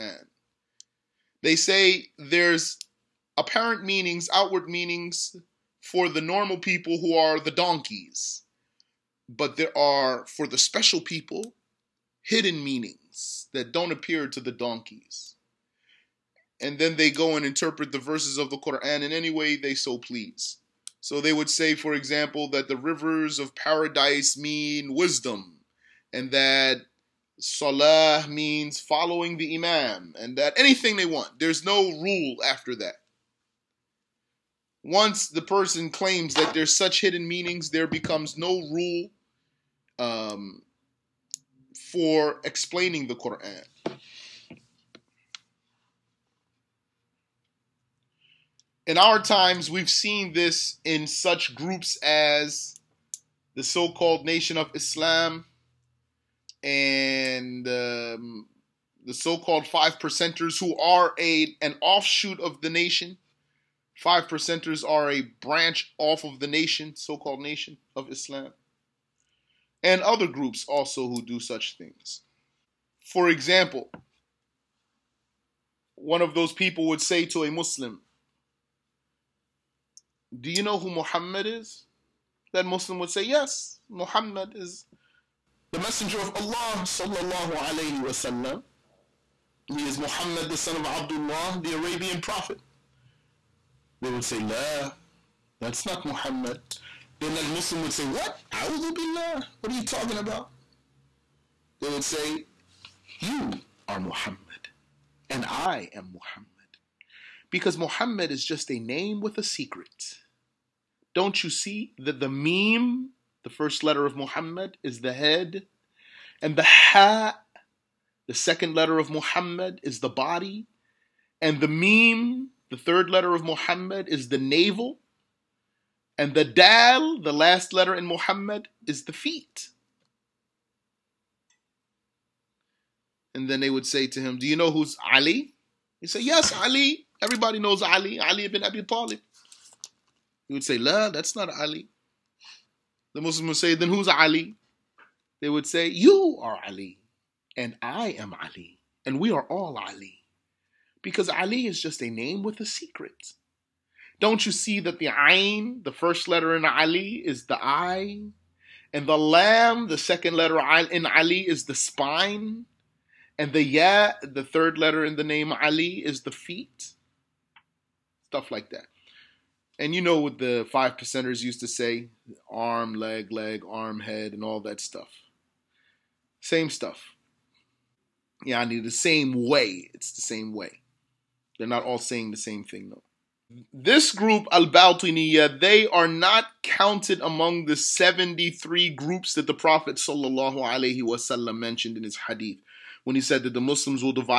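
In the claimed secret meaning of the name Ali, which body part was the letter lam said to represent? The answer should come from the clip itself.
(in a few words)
Spine.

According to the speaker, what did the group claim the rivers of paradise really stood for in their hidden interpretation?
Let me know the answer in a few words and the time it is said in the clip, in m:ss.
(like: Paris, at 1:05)
Wisdom, at 0:24.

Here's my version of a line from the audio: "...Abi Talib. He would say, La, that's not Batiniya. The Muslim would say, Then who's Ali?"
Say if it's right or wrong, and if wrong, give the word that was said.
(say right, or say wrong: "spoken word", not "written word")
wrong: "Ali", not "Batiniya".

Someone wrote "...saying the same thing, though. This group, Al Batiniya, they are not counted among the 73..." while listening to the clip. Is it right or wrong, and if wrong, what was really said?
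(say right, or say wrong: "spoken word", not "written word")
right.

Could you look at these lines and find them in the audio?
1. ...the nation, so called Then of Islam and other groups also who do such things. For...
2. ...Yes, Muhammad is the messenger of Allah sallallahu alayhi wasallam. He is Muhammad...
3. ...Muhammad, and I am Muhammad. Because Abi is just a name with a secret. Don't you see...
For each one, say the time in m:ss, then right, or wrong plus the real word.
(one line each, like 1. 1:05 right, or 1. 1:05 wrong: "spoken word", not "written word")
1. 1:06 wrong: "Nation", not "Then"
2. 1:23 right
3. 1:44 wrong: "Muhammad", not "Abi".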